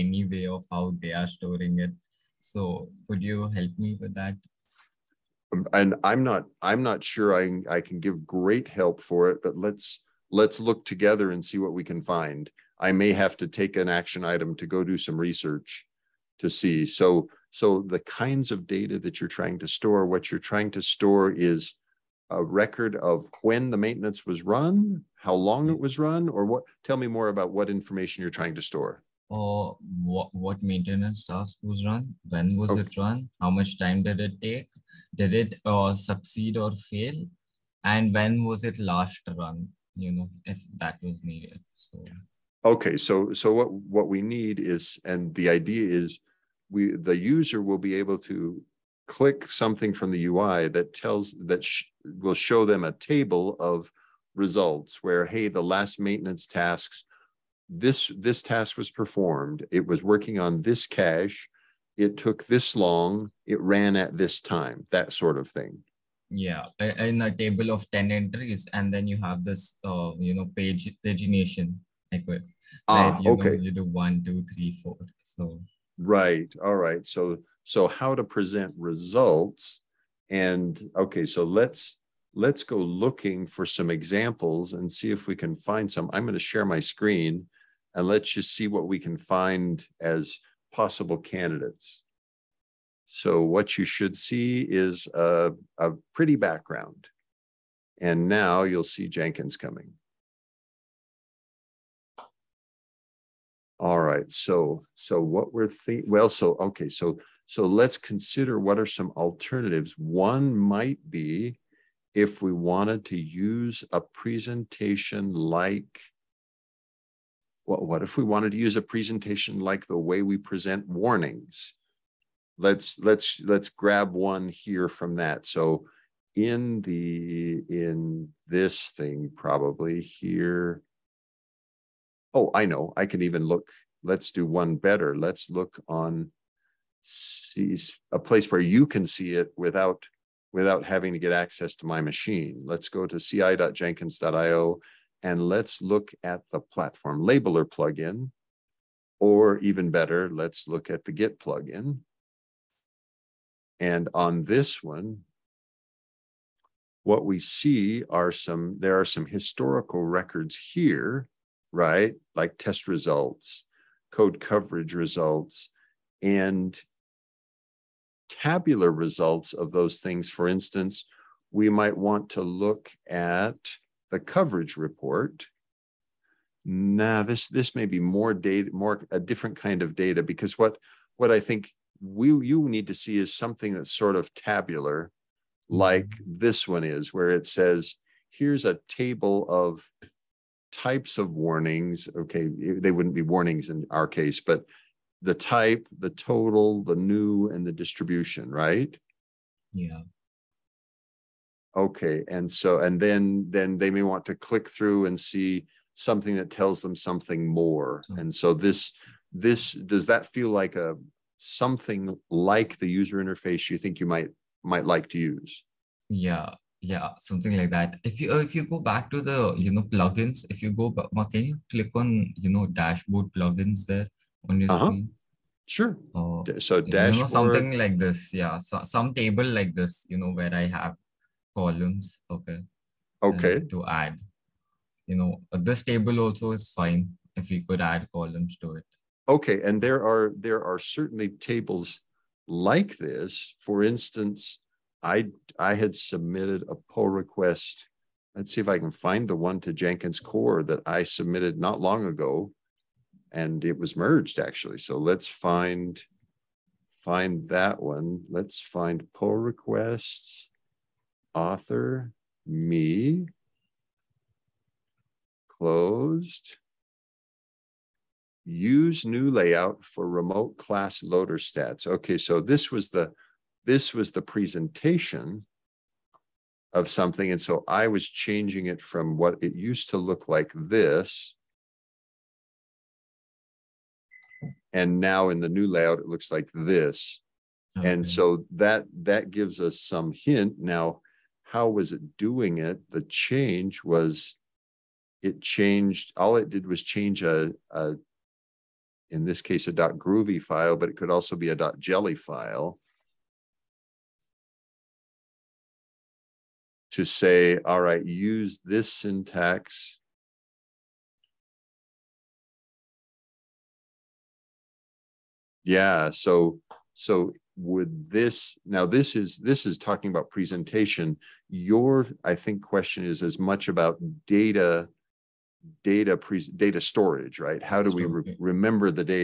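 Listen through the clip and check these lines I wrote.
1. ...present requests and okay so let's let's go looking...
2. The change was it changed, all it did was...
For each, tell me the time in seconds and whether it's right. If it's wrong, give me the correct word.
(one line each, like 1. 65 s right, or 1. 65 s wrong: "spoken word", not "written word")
1. 78 s wrong: "results", not "requests"
2. 292 s right.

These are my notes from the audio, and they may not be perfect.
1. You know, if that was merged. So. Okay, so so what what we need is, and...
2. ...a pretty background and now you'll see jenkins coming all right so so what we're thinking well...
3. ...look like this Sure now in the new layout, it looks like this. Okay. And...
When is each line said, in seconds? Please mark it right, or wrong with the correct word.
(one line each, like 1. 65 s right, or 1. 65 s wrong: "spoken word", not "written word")
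1. 39 s wrong: "needed", not "merged"
2. 95 s right
3. 279 s wrong: "And", not "Sure".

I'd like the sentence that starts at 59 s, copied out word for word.
It was working on this cache.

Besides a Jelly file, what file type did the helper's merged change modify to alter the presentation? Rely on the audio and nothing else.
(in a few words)
Groovy file.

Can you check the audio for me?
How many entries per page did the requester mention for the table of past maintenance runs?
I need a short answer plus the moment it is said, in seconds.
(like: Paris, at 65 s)
10, at 67 s.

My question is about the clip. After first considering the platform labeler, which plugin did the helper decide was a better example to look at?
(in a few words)
Git plugin.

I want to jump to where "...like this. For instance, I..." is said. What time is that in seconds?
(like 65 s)
242 s.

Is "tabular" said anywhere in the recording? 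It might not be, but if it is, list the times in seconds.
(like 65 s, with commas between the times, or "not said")
168 s, 184 s.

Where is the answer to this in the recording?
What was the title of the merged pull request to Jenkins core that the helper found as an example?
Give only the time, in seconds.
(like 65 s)
268 s.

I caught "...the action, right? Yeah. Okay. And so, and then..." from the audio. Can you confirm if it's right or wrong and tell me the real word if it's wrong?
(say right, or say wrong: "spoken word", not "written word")
wrong: "distribution", not "action".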